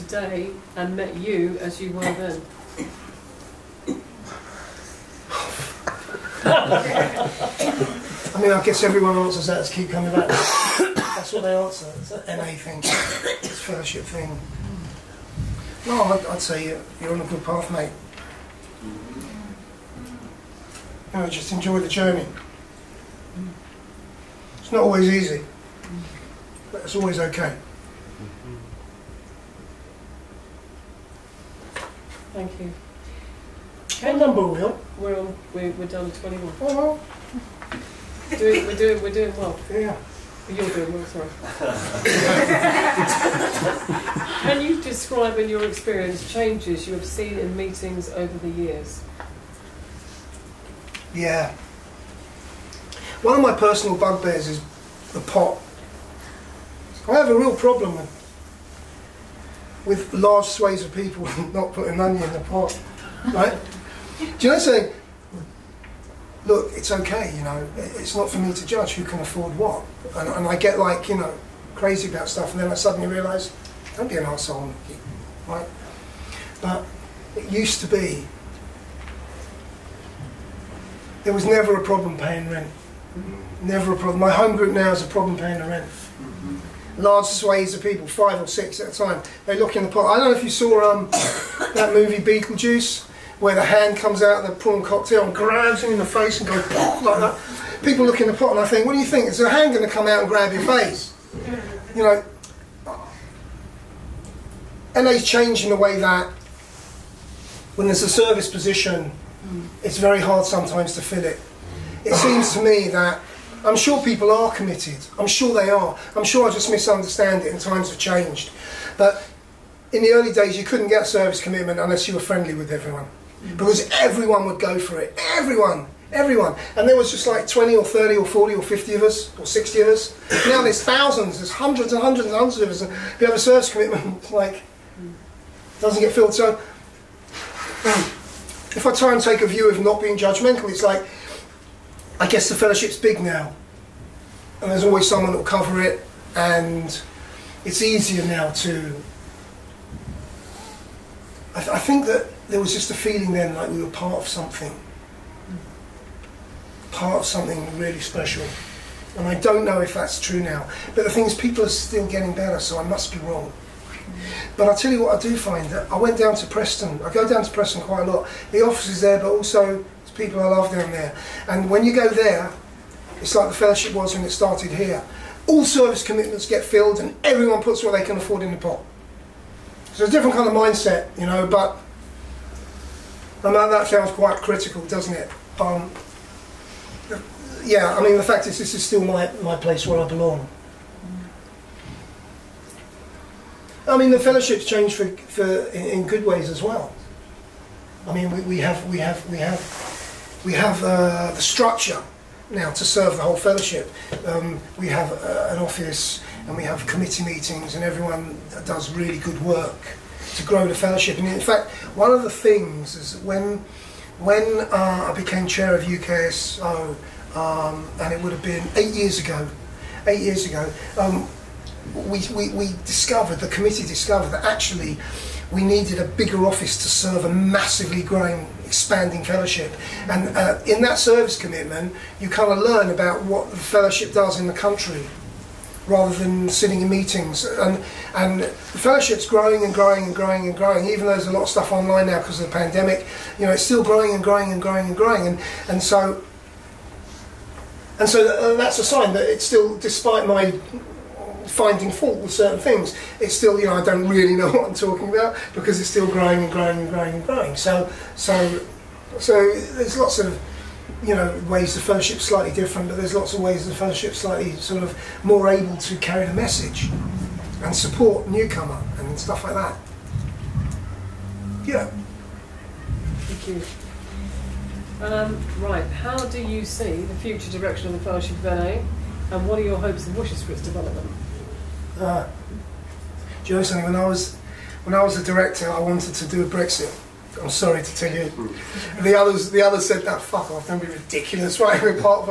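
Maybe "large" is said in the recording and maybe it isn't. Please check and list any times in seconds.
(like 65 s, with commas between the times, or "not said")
60 s, 86 s.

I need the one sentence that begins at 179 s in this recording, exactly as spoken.
So it's a different kind of mindset, you know, but I mean that sounds quite critical, doesn't it?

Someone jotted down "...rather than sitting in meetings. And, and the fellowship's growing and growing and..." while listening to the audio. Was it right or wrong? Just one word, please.
right.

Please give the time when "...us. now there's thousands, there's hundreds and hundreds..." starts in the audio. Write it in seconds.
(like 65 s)
129 s.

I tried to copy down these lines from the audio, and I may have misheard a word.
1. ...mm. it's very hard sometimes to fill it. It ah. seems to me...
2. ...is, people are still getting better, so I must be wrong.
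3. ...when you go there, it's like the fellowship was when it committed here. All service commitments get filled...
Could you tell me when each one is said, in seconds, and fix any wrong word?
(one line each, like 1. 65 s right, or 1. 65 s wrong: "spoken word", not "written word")
1. 109 s right
2. 161 s right
3. 171 s wrong: "started", not "committed".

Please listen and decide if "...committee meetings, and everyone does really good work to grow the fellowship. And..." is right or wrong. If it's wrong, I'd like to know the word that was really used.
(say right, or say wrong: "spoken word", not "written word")
right.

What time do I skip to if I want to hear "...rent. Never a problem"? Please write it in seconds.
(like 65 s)
82 s.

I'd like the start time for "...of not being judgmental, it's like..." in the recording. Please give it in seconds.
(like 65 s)
139 s.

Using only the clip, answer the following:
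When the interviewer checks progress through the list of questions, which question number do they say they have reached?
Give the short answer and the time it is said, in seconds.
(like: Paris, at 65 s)
21, at 36 s.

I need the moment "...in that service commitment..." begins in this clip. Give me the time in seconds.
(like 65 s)
230 s.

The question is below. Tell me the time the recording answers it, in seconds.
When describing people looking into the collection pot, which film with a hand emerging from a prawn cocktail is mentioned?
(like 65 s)
92 s.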